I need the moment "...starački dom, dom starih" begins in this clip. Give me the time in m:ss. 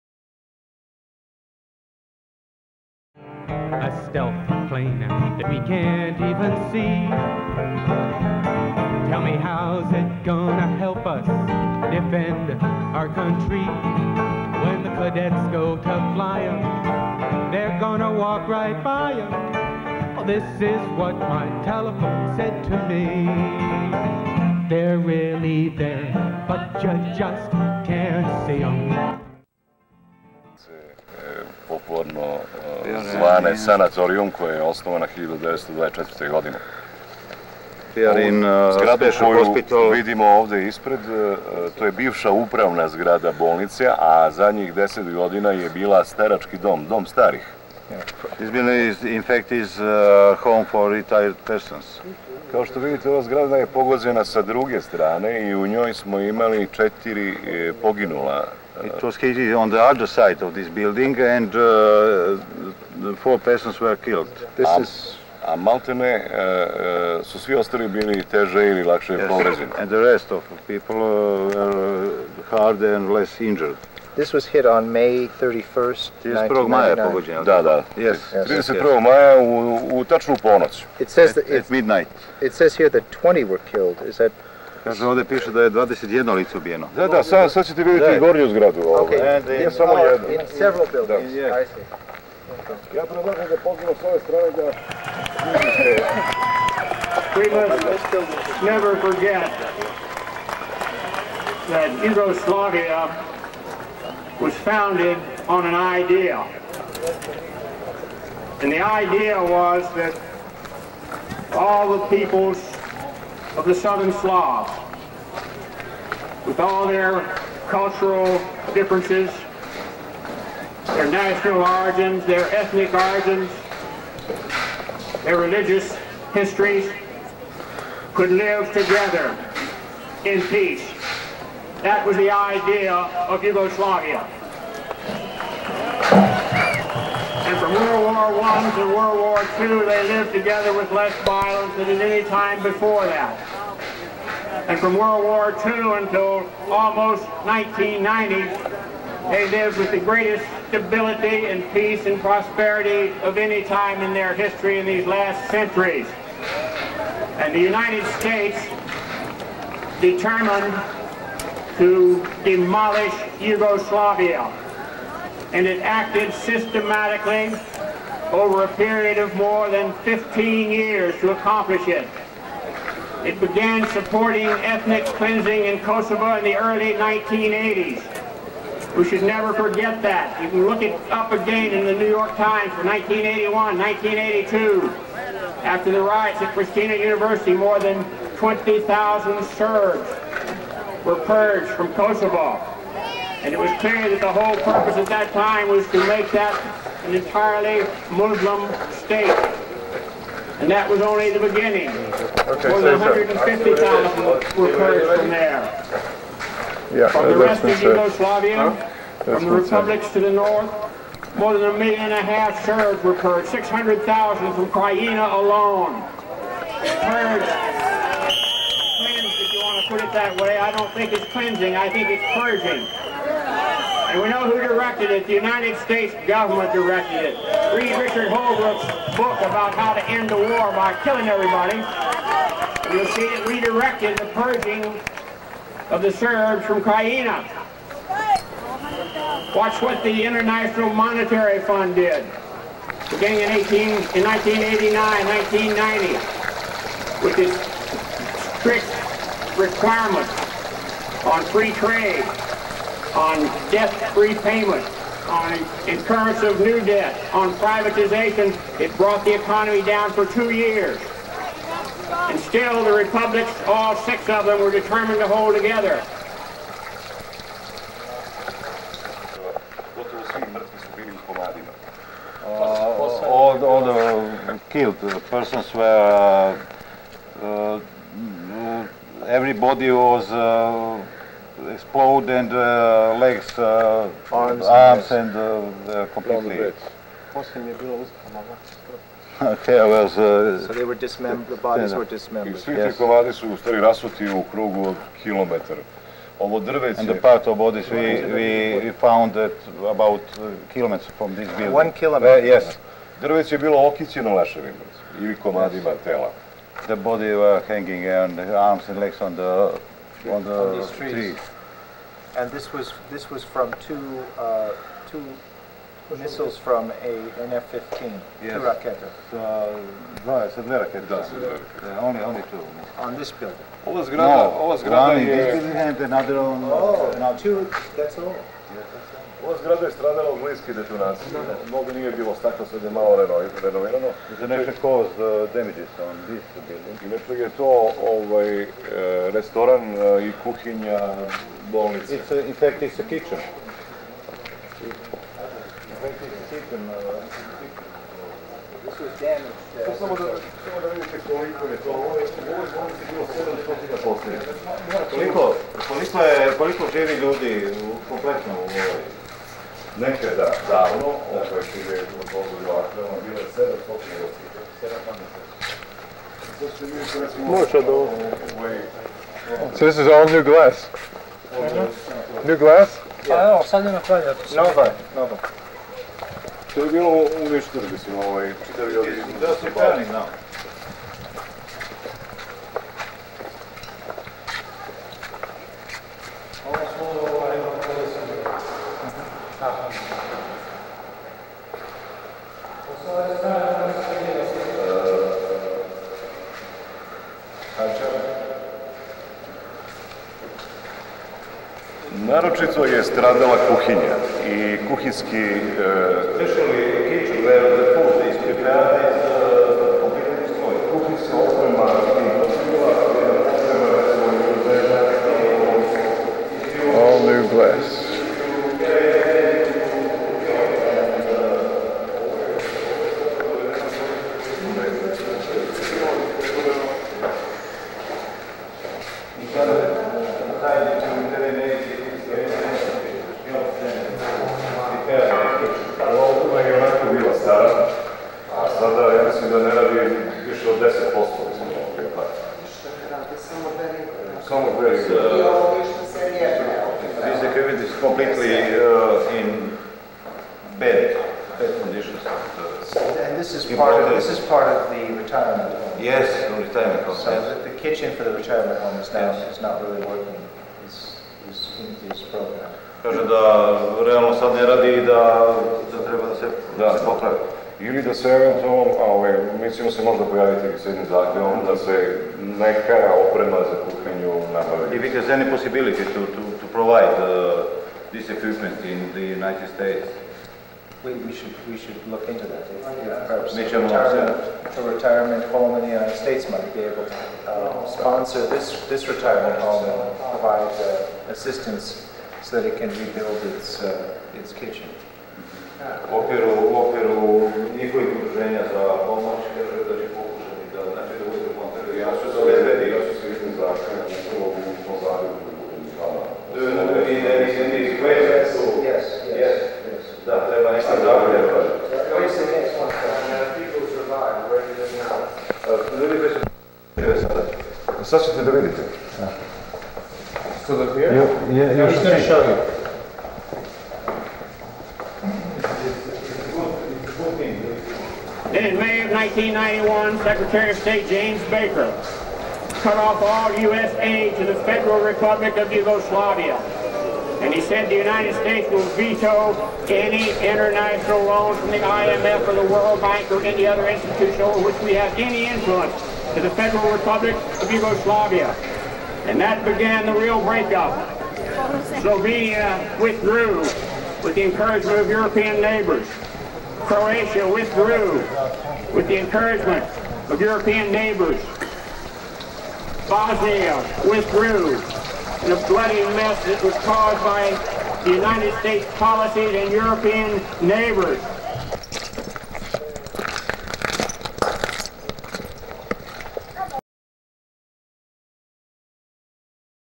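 0:46.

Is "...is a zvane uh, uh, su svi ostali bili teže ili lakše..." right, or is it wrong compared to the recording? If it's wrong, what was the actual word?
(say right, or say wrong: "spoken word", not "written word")
wrong: "maltene", not "zvane".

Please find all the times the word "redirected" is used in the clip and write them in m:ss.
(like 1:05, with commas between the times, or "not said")
3:53.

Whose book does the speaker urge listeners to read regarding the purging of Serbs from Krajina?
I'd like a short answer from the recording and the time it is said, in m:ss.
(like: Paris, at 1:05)
Richard Holbrooke, at 3:47.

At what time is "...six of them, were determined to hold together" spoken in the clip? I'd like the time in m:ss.
4:23.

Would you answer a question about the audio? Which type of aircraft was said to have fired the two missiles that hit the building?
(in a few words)
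F-15.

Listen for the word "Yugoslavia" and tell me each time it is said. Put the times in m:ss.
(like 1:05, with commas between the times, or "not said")
1:42, 2:13, 2:43, 3:27, 8:55, 9:07.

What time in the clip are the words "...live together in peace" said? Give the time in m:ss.
2:08.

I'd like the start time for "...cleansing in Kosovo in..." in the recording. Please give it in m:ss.
2:55.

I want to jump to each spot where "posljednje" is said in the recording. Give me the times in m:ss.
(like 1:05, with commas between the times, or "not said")
5:54, 6:03.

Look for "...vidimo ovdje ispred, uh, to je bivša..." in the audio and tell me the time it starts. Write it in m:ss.
0:39.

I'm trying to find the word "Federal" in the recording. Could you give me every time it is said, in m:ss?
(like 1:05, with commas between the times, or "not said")
8:54, 9:06.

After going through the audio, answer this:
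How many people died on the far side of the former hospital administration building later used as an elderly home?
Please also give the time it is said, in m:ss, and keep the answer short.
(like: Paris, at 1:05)
4, at 0:56.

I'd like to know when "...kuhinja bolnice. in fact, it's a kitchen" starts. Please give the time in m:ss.
5:40.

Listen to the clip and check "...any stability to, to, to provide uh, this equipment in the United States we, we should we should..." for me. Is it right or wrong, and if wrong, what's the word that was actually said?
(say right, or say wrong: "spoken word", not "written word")
wrong: "possibility", not "stability".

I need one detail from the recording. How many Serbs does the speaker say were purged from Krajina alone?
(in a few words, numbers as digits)
600,000.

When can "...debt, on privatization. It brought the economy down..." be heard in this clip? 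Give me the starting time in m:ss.
4:16.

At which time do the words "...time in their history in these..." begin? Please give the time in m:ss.
2:33.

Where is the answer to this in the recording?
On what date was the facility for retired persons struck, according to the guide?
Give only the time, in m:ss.
1:14.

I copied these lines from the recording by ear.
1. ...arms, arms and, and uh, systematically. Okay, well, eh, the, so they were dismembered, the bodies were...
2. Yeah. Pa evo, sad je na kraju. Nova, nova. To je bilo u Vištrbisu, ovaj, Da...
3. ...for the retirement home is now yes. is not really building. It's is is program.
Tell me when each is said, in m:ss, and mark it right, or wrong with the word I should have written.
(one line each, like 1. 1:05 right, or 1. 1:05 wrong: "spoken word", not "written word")
1. 4:44 wrong: "completely", not "systematically"
2. 6:13 right
3. 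7:38 wrong: "working", not "building".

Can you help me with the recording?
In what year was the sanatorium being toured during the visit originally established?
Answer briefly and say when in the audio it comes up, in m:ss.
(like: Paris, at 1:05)
1924, at 0:35.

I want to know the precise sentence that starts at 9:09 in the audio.
And that began the real breakup.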